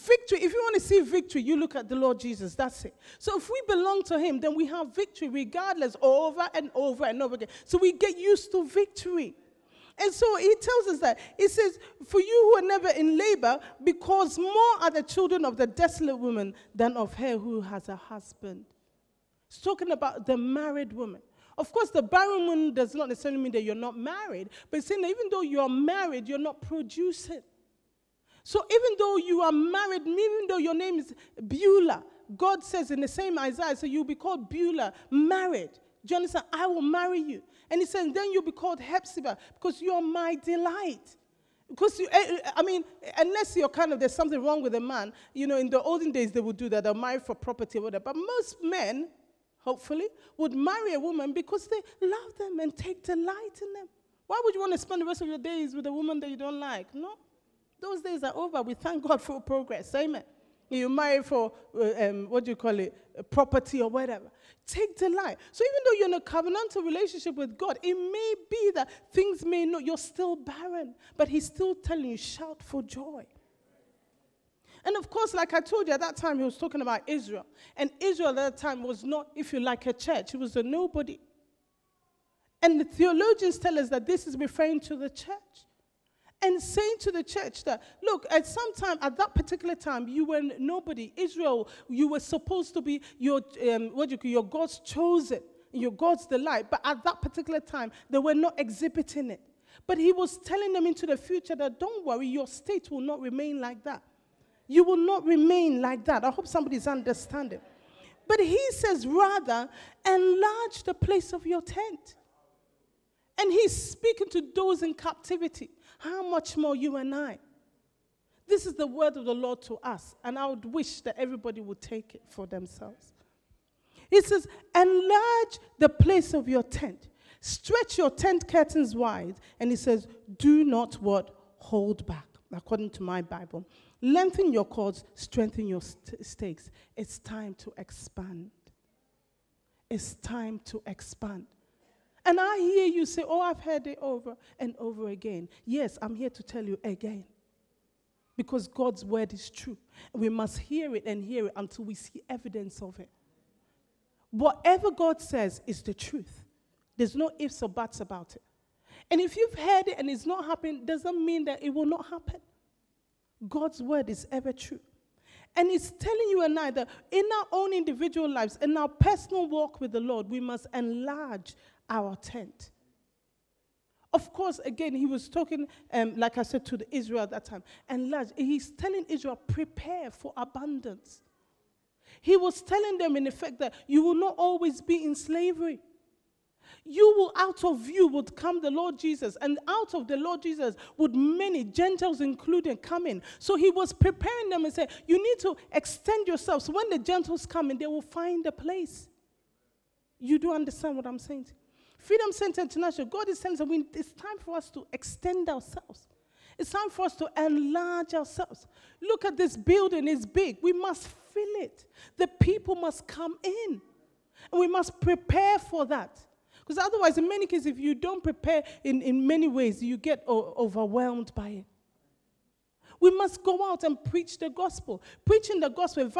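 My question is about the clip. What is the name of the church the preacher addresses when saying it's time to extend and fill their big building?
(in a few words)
Freedom Center International.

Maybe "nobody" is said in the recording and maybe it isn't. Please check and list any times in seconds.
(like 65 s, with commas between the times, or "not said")
80 s, 90 s.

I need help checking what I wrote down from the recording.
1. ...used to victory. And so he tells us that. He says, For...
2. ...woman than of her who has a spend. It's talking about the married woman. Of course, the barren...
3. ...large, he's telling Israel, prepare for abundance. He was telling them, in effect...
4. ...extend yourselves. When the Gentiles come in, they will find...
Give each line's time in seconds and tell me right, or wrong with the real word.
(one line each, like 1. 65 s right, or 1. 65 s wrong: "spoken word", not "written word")
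1. 8 s right
2. 16 s wrong: "husband", not "spend"
3. 178 s right
4. 195 s right.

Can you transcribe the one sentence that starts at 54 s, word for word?
Why would you want to spend the rest of your days with a woman that you don't like?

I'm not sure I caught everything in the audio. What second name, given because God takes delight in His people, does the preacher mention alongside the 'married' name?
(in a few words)
Hepzibah.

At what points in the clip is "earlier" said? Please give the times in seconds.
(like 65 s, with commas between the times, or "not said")
not said.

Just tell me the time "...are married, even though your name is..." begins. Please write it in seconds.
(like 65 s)
29 s.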